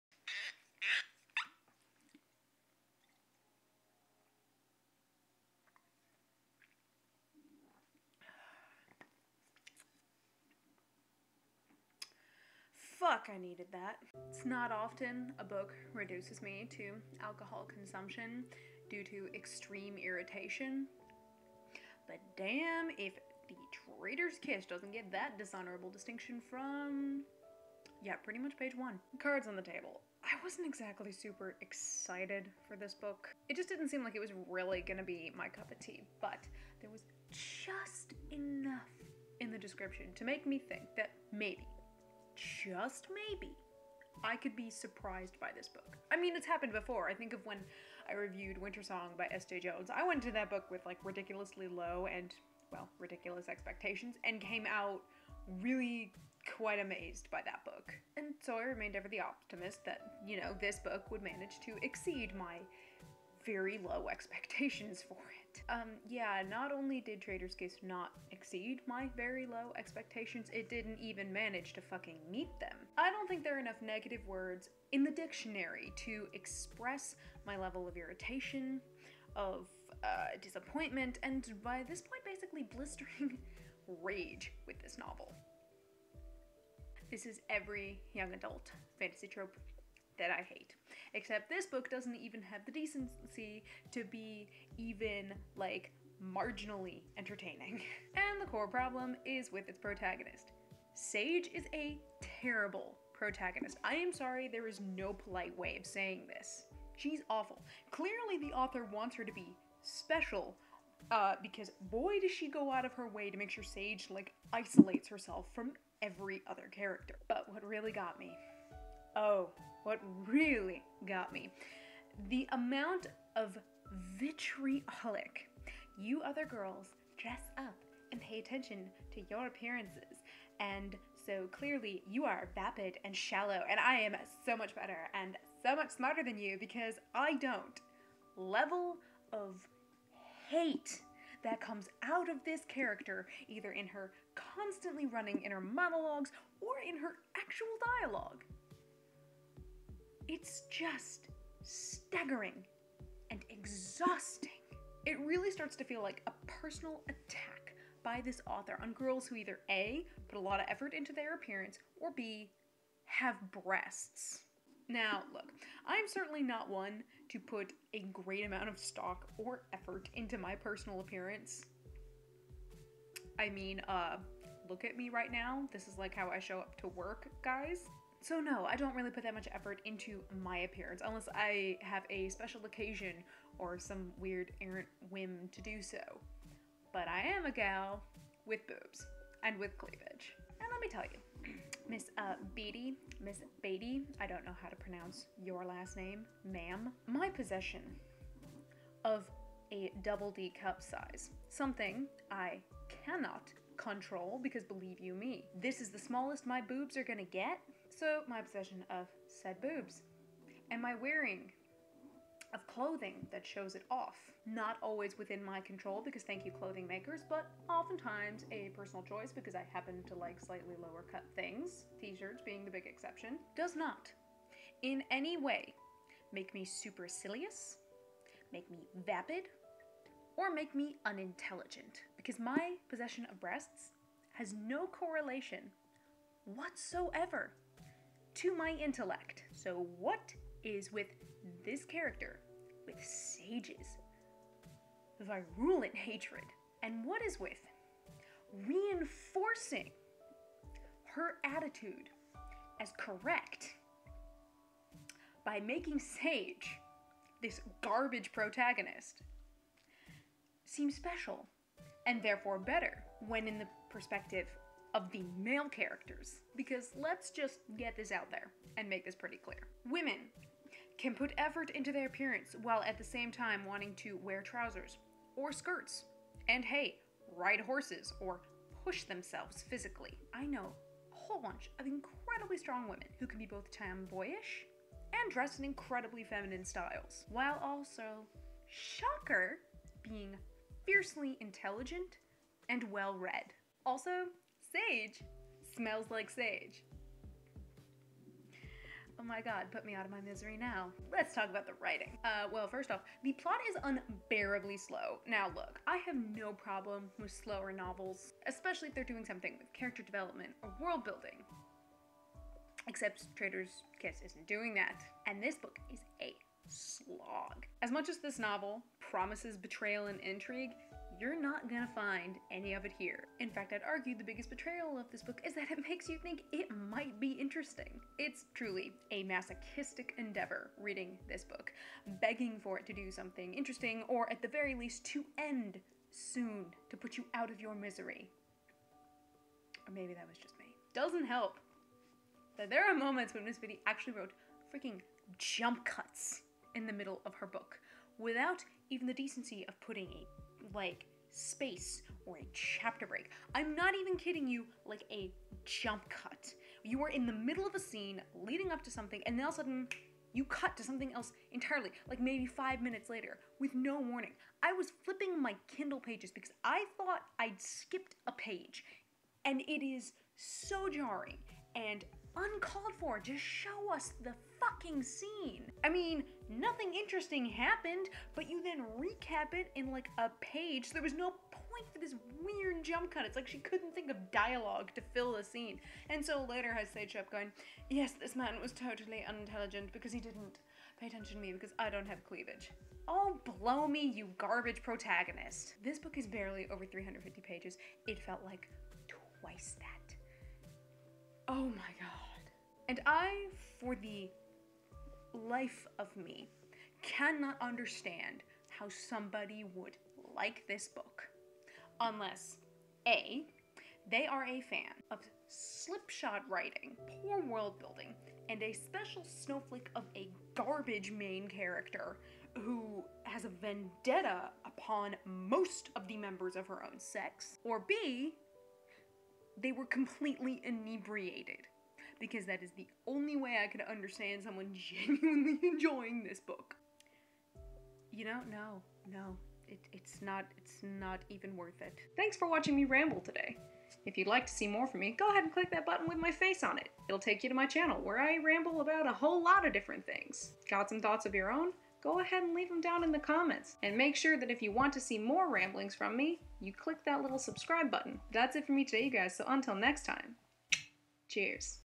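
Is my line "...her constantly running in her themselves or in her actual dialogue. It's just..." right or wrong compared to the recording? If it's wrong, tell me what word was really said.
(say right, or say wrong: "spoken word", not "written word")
wrong: "monologues", not "themselves".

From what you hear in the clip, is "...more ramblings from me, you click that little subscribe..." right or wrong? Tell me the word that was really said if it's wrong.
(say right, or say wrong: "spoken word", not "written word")
right.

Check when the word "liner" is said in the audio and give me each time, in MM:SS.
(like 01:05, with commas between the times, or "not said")
not said.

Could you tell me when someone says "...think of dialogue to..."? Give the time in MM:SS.
06:23.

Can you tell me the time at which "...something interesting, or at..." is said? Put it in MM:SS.
05:33.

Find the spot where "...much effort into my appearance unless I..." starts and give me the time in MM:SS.
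02:59.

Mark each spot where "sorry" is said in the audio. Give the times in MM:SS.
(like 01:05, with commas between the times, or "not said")
01:44.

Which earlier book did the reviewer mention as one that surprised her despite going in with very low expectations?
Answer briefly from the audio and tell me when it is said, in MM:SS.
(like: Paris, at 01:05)
Wintersong, at 00:48.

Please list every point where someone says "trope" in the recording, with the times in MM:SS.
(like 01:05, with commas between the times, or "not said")
01:29.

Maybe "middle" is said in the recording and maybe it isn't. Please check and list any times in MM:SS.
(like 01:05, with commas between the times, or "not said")
05:46, 05:57.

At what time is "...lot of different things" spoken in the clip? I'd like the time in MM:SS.
07:29.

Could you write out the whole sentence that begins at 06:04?
I was flipping my Kindle pages because I thought I'd skipped a page, and it is so jarring and uncalled for.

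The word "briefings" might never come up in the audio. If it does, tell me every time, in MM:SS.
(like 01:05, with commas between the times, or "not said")
not said.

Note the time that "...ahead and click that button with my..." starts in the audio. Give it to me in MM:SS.
07:25.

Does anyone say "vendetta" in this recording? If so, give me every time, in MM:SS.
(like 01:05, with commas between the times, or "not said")
07:03.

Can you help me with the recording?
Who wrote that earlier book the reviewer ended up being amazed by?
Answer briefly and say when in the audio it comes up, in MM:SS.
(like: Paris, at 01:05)
S. Jae-Jones, at 00:49.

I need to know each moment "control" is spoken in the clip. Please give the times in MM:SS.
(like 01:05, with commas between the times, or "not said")
03:23, 03:35.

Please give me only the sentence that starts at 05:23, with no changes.
In fact, I'd argue the biggest betrayal of this book is that it makes you think it might be interesting.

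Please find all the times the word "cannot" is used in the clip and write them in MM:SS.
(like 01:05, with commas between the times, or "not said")
03:23, 06:47.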